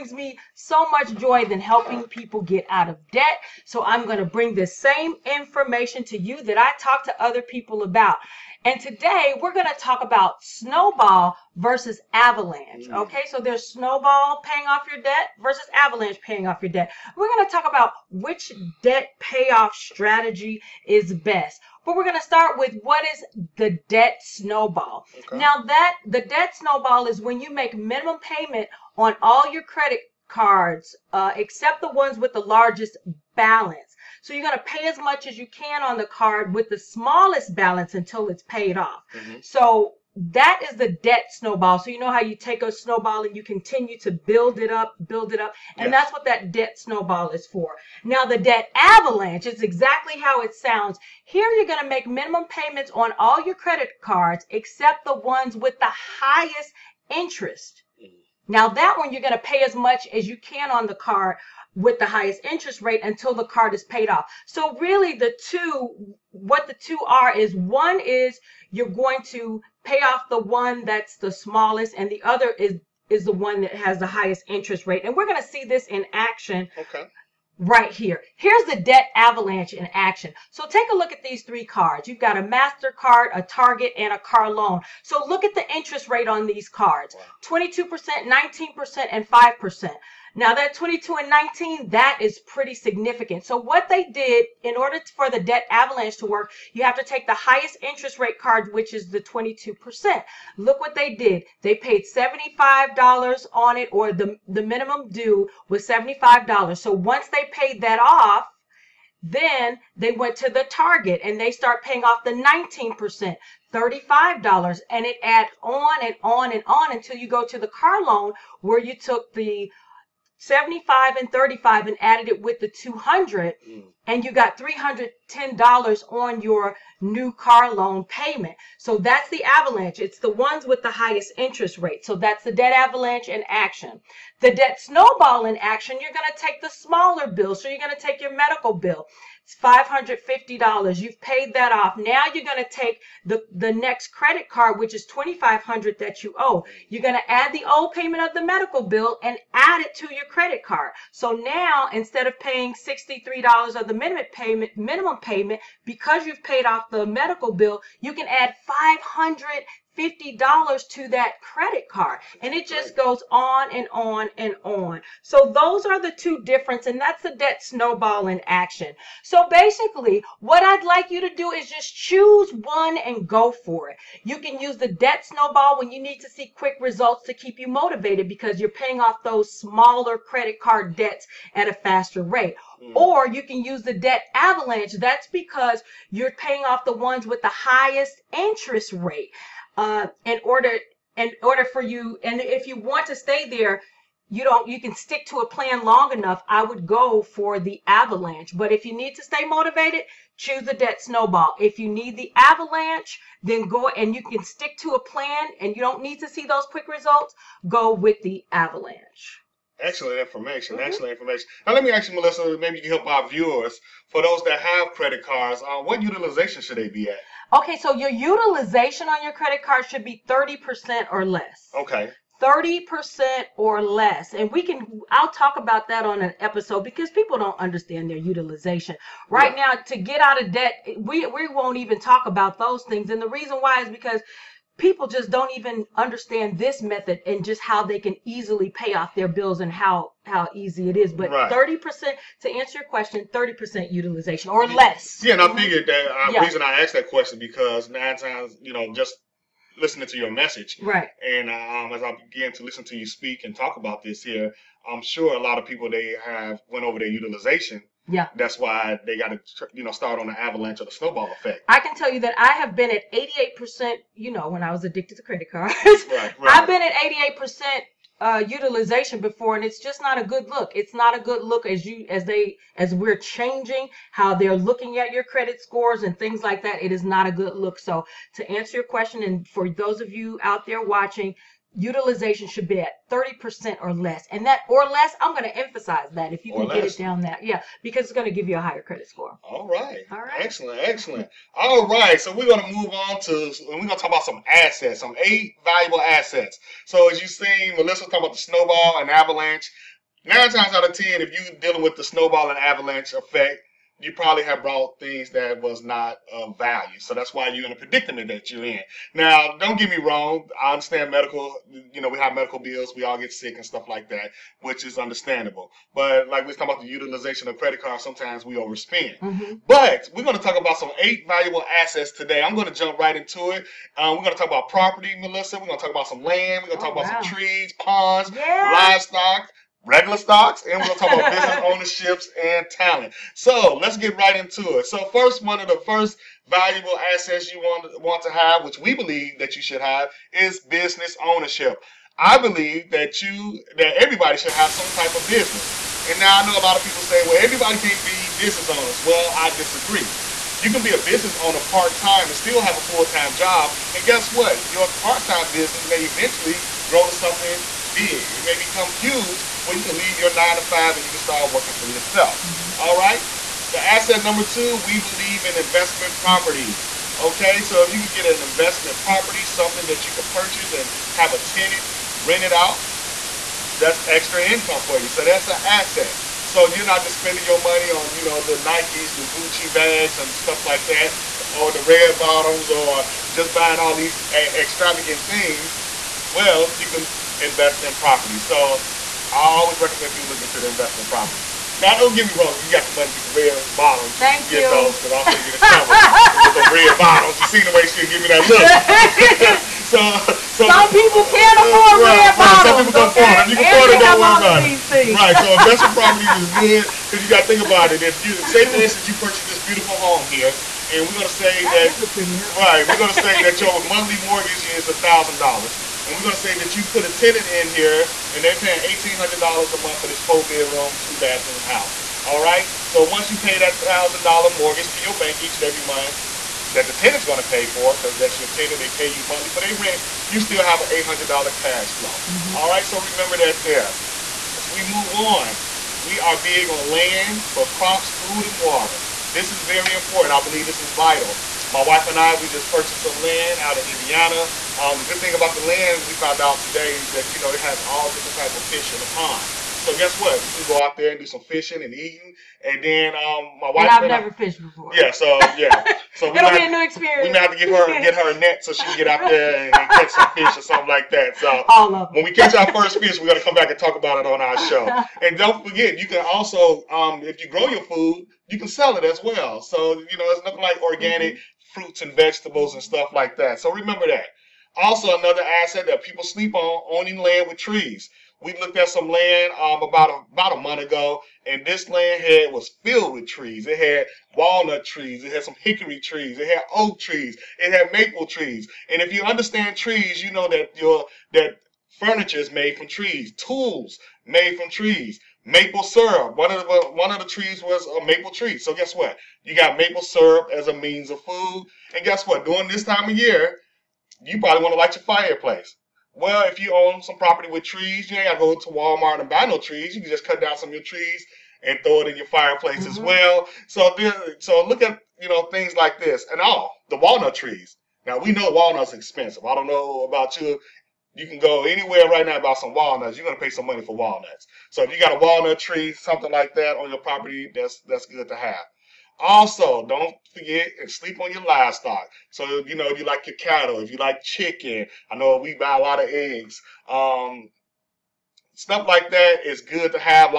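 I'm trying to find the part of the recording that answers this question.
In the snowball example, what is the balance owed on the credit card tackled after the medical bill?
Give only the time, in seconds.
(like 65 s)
145 s.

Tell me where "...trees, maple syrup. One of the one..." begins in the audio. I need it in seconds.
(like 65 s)
494 s.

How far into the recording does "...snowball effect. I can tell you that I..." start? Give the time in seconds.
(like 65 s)
260 s.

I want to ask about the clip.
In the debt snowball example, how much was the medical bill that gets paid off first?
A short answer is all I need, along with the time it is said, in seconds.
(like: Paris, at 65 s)
$550, at 139 s.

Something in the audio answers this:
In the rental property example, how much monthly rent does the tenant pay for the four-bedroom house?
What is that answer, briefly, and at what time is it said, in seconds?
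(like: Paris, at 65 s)
$1,800, at 418 s.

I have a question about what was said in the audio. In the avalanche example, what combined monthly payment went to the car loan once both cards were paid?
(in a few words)
$310.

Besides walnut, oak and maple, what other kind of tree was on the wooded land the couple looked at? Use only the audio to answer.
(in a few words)
Hickory.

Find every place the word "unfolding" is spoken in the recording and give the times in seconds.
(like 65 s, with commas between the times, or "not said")
not said.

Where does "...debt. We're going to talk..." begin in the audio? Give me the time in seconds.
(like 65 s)
16 s.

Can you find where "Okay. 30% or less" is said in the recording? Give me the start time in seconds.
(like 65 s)
221 s.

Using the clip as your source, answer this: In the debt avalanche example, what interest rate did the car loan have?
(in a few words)
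5%.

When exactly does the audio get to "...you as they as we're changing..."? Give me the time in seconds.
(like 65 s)
271 s.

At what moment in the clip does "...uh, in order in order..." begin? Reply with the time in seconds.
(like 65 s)
189 s.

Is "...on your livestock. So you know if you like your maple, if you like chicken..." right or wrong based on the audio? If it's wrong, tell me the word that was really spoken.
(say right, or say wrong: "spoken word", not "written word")
wrong: "cattle", not "maple".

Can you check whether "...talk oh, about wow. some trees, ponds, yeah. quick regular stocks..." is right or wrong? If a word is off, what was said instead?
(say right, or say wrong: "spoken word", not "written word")
wrong: "livestock", not "quick".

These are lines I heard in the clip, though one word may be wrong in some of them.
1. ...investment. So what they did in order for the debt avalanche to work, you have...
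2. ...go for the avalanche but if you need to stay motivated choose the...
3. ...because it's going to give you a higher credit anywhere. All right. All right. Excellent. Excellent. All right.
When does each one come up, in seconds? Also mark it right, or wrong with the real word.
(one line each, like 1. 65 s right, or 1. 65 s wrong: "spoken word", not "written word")
1. 92 s wrong: "significant", not "investment"
2. 196 s right
3. 287 s wrong: "score", not "anywhere".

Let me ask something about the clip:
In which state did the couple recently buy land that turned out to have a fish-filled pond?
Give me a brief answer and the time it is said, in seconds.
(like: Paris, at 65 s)
Indiana, at 443 s.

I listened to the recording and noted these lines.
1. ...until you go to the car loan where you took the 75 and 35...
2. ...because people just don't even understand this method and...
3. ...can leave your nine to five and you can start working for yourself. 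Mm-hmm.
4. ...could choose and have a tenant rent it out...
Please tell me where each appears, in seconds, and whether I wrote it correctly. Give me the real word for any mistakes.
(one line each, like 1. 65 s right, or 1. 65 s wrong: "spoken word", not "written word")
1. 116 s right
2. 233 s right
3. 359 s right
4. 370 s wrong: "purchase", not "choose".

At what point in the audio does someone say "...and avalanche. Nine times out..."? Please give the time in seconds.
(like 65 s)
298 s.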